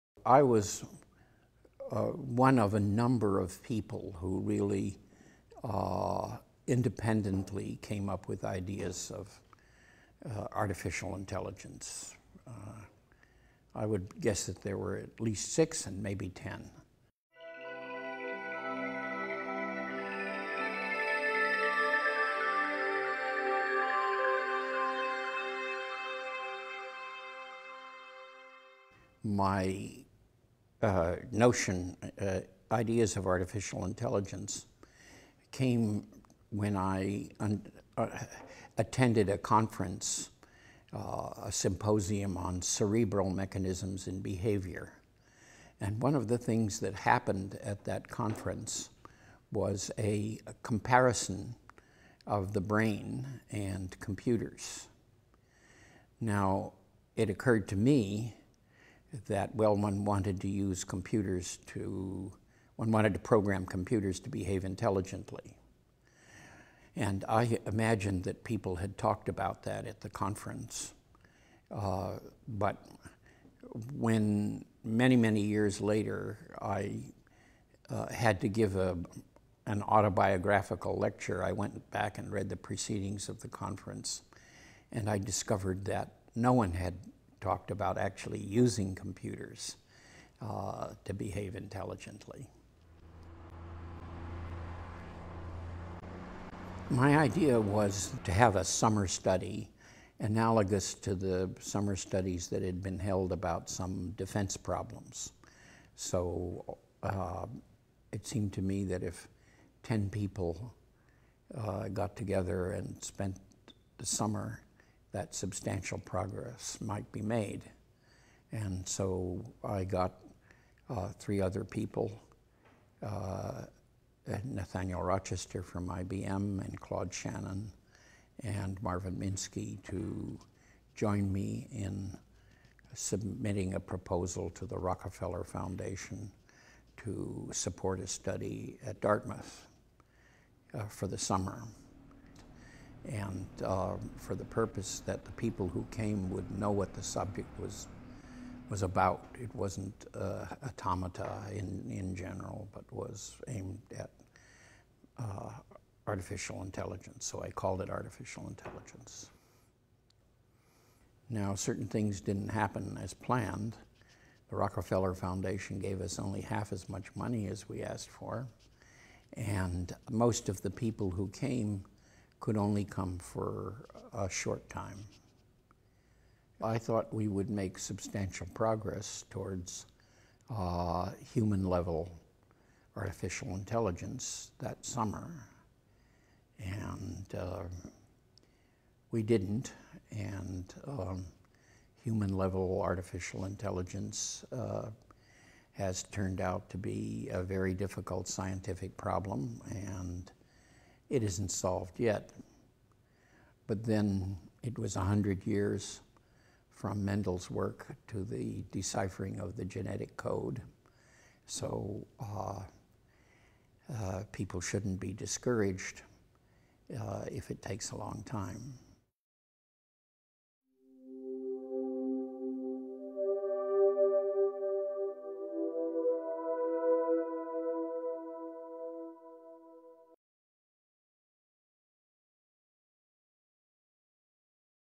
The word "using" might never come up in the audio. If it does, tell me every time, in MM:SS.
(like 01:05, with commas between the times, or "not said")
01:28.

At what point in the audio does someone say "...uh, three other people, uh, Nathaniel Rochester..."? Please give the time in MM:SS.
02:00.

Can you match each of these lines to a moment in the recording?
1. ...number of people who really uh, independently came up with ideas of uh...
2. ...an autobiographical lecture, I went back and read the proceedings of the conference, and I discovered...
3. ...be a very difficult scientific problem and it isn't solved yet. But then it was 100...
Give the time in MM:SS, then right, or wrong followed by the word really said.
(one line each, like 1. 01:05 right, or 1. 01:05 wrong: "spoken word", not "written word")
1. 00:02 right
2. 01:19 right
3. 03:16 right.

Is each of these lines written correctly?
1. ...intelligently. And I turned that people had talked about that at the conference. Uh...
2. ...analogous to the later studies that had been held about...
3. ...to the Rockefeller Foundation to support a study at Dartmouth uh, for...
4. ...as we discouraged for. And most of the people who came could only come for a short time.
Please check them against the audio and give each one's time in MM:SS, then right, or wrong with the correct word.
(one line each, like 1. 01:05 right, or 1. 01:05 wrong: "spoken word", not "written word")
1. 01:04 wrong: "imagined", not "turned"
2. 01:40 wrong: "summer", not "later"
3. 02:14 right
4. 02:47 wrong: "asked", not "discouraged".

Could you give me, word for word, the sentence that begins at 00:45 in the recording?
And one of the things that happened at that conference was a, a comparison of the brain and computers.